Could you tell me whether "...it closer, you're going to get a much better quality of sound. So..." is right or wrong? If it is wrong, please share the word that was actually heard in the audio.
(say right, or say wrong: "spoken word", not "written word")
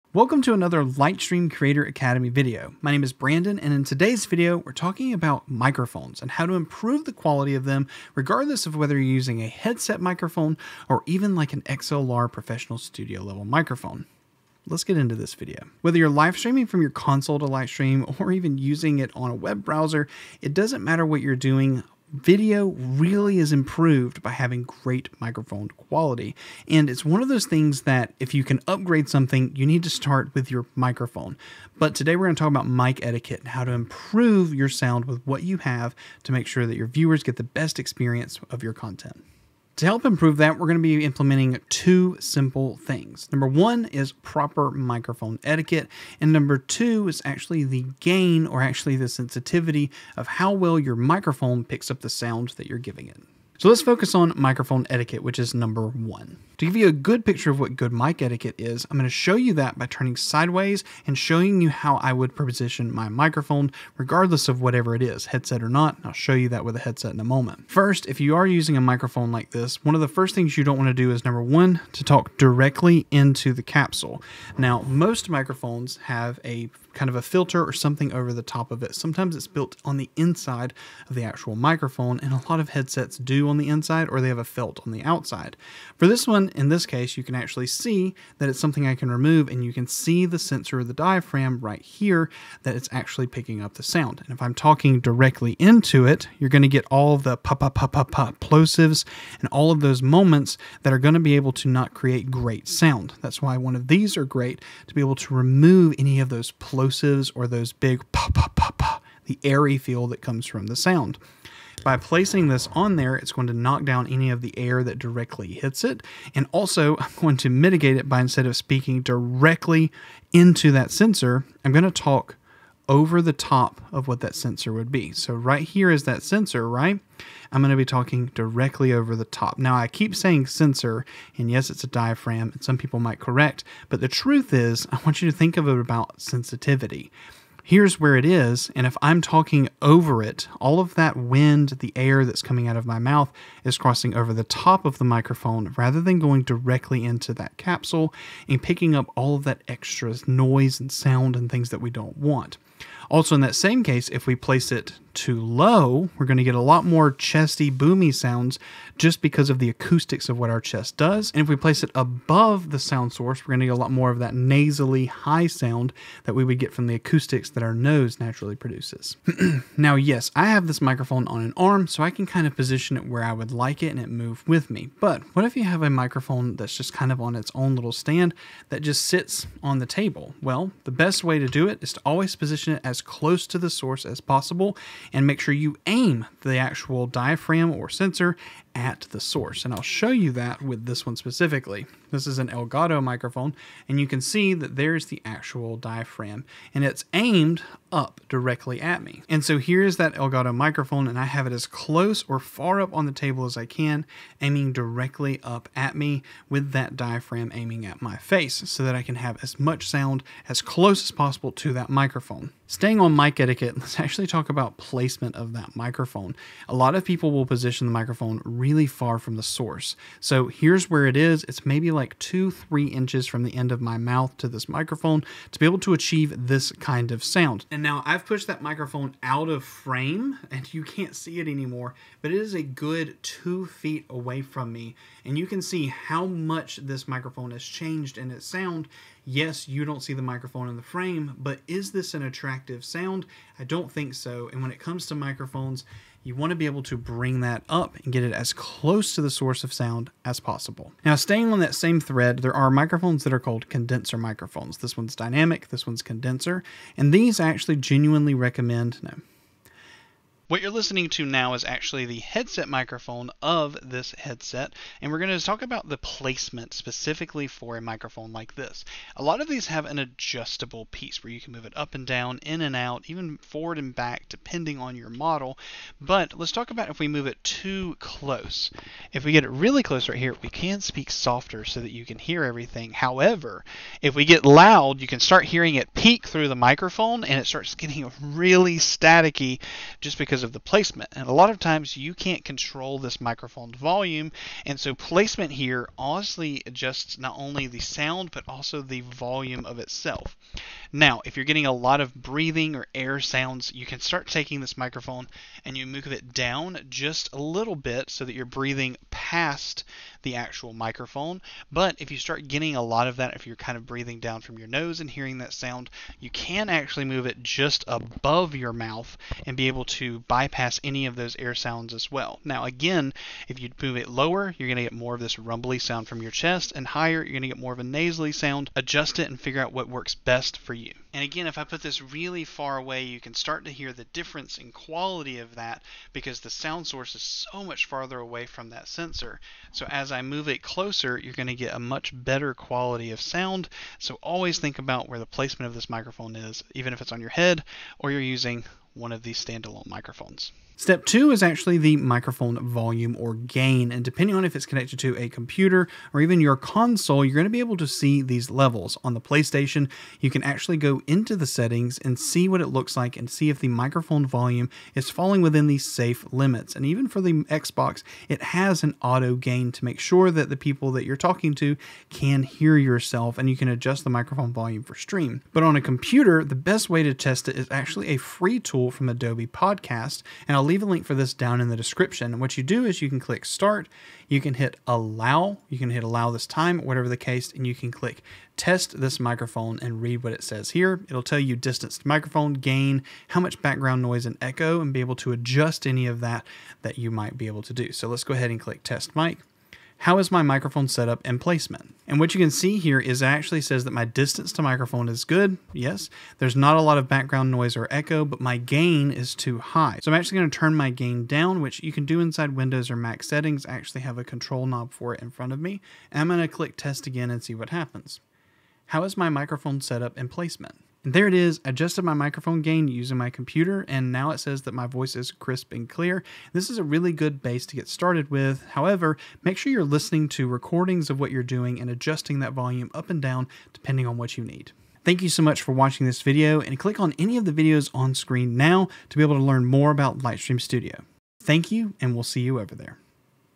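right.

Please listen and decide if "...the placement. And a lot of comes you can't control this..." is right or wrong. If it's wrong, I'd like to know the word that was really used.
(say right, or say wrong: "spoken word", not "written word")
wrong: "times", not "comes".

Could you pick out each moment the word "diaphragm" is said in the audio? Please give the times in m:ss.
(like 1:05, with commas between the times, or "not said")
1:30, 2:11, 3:07, 3:15, 3:26.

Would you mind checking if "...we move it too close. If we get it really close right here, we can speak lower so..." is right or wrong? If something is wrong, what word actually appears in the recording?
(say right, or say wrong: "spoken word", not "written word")
wrong: "softer", not "lower".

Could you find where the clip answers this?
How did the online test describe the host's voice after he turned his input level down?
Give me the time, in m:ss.
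7:05.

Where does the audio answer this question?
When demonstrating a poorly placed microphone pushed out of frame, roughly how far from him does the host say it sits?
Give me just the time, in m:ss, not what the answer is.
3:53.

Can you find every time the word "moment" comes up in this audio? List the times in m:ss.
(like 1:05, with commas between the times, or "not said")
1:07, 1:40.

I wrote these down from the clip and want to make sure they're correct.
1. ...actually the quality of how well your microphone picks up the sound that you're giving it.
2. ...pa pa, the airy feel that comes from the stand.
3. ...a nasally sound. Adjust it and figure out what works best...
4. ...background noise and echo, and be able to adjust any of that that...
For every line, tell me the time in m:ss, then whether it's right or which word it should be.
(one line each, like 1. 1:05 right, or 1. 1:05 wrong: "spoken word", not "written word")
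1. 0:48 wrong: "sensitivity", not "quality"
2. 1:48 wrong: "sound", not "stand"
3. 5:27 right
4. 6:33 right.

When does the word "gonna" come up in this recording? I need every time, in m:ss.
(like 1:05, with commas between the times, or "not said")
6:50, 6:56.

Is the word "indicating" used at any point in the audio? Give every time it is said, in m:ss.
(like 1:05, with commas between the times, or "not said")
not said.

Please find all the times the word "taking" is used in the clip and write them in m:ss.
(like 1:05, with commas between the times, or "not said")
5:04.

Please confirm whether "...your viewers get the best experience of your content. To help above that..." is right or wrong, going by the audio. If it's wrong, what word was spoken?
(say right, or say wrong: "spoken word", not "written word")
wrong: "improve", not "above".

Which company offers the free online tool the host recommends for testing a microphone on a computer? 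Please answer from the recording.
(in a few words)
Adobe Podcast.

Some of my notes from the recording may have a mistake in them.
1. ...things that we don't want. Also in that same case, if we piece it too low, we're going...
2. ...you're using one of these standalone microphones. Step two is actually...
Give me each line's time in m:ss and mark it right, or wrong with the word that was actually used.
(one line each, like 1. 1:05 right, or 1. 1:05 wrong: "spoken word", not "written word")
1. 2:31 wrong: "place", not "piece"
2. 5:48 right.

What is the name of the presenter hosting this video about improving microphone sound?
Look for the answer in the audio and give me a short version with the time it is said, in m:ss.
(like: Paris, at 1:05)
Brandon, at 0:03.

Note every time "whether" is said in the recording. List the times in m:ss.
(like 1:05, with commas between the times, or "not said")
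0:08, 0:15.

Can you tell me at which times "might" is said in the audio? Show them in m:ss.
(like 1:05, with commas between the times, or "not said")
2:12, 6:37.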